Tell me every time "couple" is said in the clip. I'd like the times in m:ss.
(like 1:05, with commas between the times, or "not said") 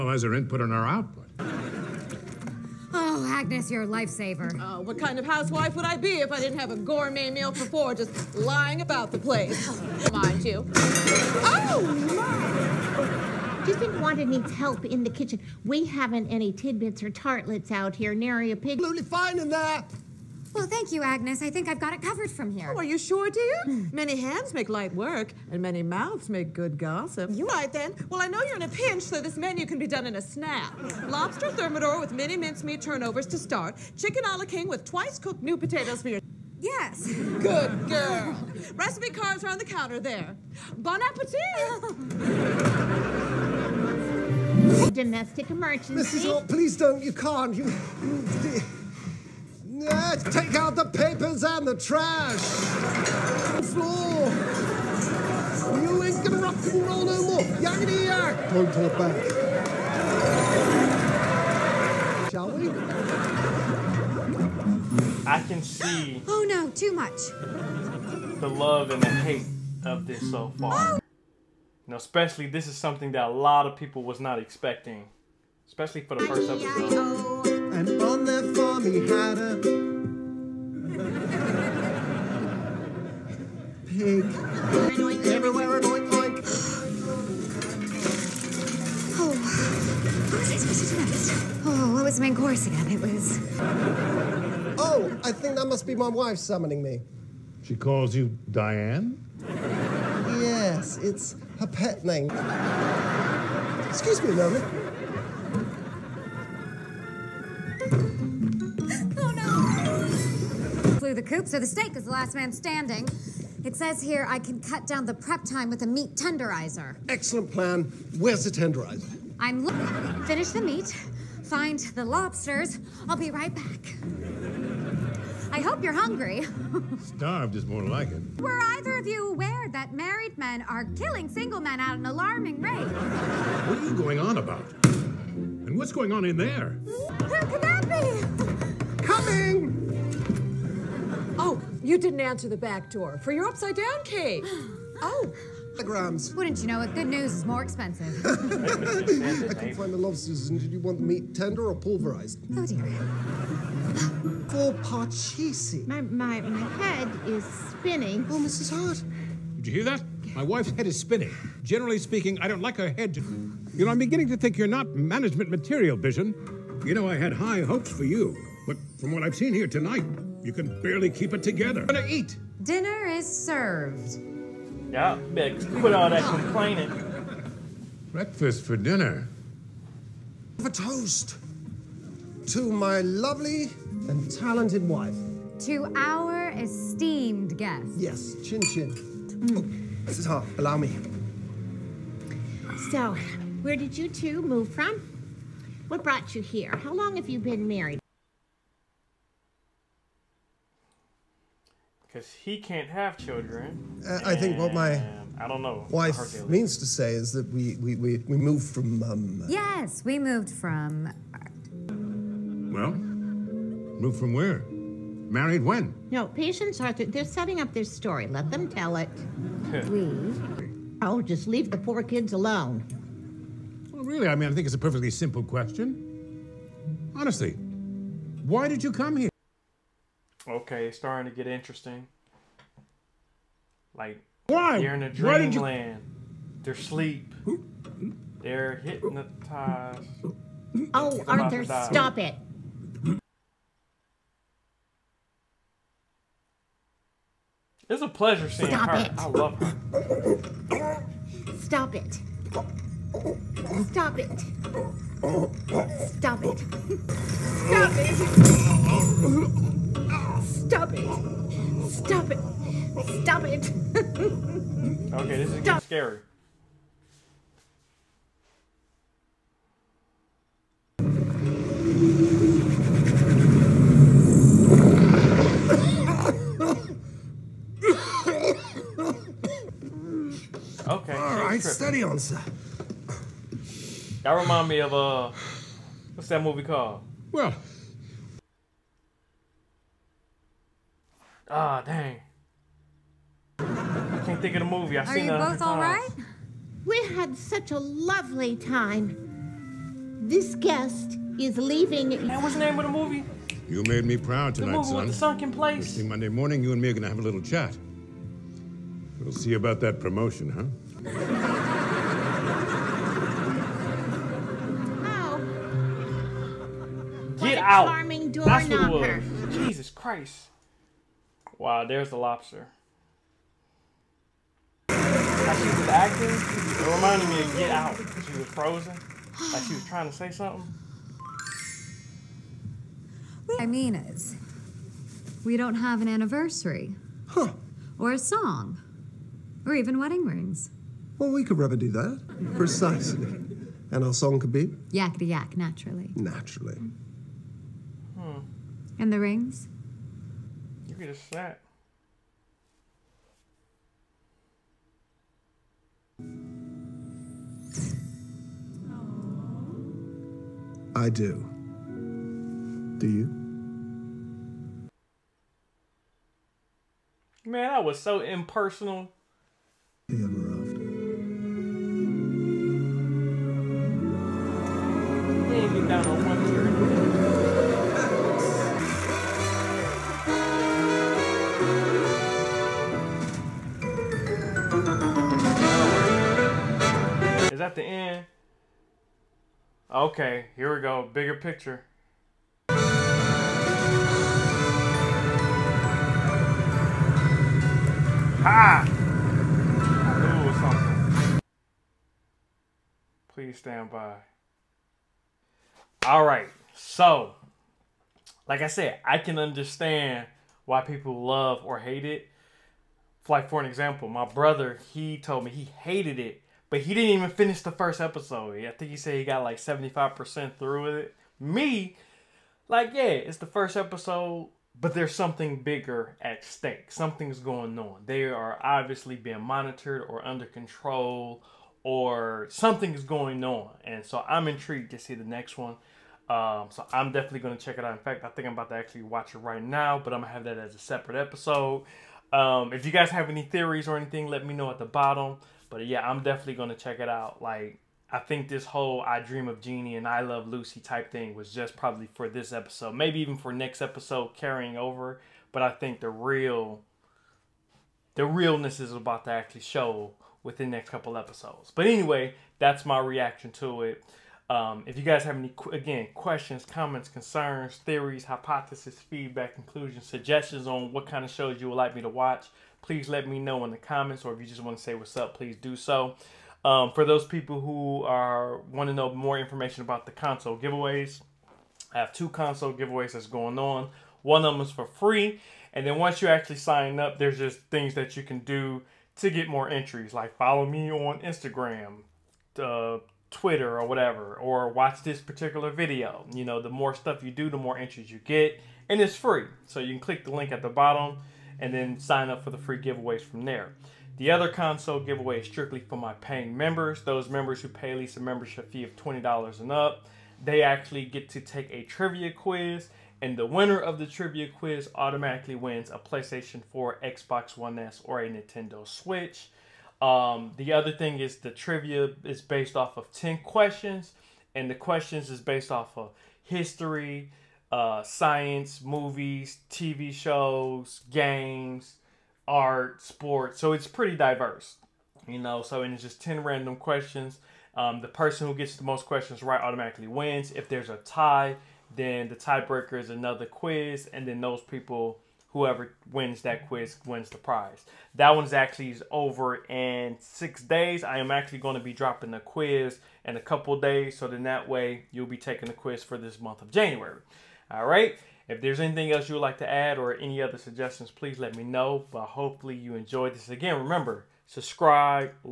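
7:40, 9:13.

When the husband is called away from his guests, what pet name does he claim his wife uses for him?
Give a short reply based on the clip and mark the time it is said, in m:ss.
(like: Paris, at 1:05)
Diane, at 1:38.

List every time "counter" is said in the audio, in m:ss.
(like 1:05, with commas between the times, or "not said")
0:39.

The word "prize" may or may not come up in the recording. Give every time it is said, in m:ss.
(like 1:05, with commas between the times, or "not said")
9:07.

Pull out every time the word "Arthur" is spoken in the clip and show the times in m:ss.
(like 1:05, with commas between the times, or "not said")
3:36, 4:01.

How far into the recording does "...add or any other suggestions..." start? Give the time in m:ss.
9:19.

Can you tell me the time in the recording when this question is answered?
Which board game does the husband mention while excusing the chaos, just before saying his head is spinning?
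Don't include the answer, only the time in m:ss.
2:34.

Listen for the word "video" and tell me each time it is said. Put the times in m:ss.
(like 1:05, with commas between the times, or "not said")
8:15.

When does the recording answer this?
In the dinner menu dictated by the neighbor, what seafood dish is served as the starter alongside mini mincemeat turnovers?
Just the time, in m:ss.
0:31.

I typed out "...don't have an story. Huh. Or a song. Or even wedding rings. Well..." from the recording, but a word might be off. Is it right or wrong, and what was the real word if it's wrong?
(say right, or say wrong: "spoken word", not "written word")
wrong: "anniversary", not "story".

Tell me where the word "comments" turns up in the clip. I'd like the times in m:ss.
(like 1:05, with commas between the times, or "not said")
7:46, 7:53.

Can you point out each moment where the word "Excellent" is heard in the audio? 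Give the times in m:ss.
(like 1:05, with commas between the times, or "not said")
1:57.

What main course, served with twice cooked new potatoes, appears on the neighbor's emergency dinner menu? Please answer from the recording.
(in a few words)
Chicken a la king.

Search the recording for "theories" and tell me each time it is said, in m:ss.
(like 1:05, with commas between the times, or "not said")
7:23, 7:47.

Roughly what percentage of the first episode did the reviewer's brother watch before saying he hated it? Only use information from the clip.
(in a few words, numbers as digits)
75%.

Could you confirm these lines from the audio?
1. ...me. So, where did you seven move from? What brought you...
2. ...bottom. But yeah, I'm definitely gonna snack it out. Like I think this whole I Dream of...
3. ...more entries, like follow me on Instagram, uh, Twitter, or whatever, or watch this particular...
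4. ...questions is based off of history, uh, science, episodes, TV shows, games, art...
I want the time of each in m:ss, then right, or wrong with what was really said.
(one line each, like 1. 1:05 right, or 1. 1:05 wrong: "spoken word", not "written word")
1. 3:10 wrong: "two", not "seven"
2. 7:24 wrong: "check", not "snack"
3. 8:09 right
4. 8:44 wrong: "movies", not "episodes".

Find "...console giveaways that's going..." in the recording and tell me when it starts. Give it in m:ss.
8:02.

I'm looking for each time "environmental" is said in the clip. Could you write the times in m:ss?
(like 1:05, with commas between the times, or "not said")
not said.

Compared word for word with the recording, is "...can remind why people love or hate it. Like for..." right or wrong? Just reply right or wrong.
wrong.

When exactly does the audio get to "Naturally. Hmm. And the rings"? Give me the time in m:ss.
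5:46.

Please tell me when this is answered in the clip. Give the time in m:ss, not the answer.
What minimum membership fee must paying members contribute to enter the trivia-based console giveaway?
8:28.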